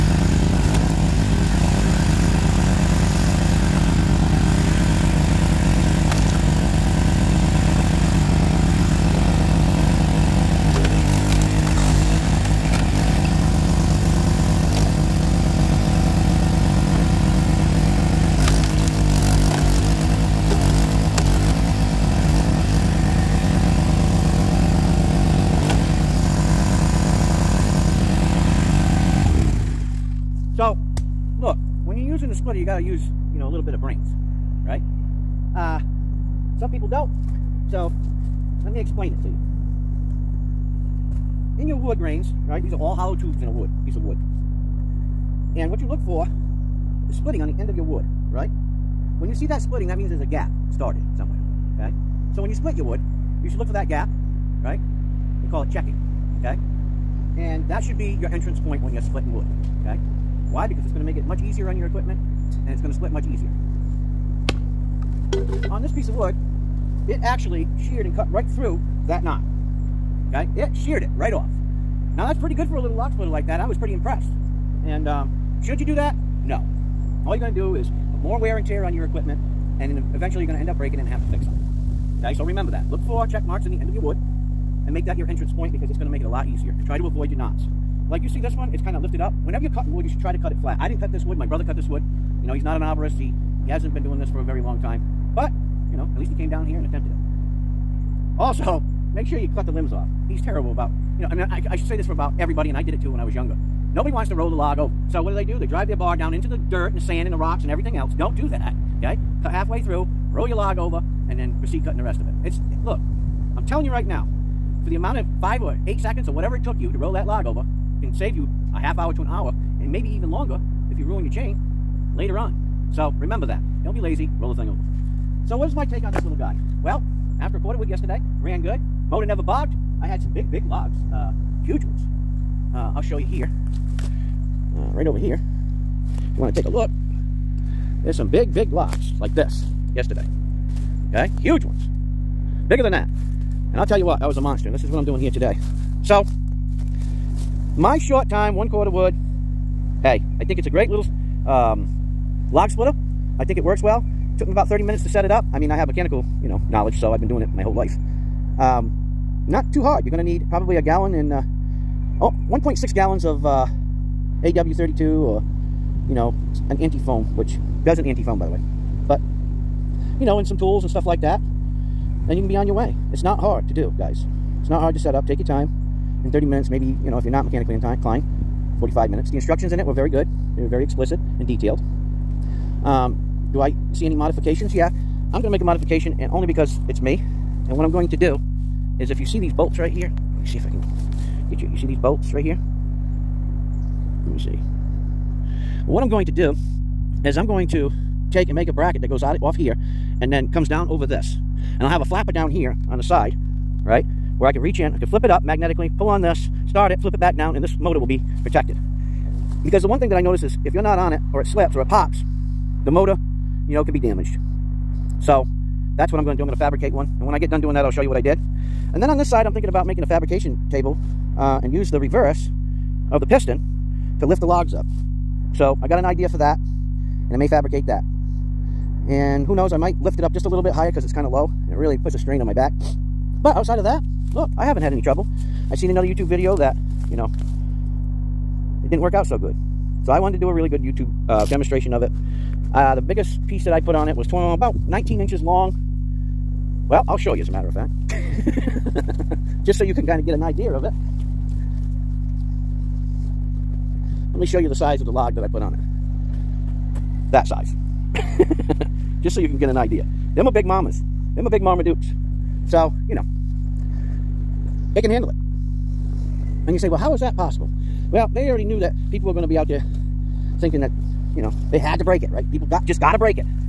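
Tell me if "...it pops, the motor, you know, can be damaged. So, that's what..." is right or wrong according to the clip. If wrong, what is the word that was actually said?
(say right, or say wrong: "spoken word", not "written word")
right.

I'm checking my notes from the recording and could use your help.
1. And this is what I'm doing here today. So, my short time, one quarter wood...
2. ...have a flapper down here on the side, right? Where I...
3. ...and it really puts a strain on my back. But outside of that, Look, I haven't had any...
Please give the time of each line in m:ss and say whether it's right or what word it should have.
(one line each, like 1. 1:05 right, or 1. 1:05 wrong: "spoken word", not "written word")
1. 2:24 right
2. 3:21 right
3. 3:51 right.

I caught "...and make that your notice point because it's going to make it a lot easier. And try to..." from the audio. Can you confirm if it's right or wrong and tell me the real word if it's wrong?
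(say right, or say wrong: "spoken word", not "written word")
wrong: "entrance", not "notice".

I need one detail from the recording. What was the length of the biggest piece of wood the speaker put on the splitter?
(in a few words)
19 inches.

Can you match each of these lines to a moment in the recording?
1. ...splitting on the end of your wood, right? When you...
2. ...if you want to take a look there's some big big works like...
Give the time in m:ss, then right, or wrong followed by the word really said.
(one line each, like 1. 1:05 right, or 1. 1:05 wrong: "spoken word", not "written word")
1. 0:47 right
2. 2:16 wrong: "locks", not "works".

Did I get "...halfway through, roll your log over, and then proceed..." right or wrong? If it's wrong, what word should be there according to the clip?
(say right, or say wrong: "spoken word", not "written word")
right.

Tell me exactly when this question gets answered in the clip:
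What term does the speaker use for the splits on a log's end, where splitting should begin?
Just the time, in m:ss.
0:55.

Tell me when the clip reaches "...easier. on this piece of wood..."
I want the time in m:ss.
1:03.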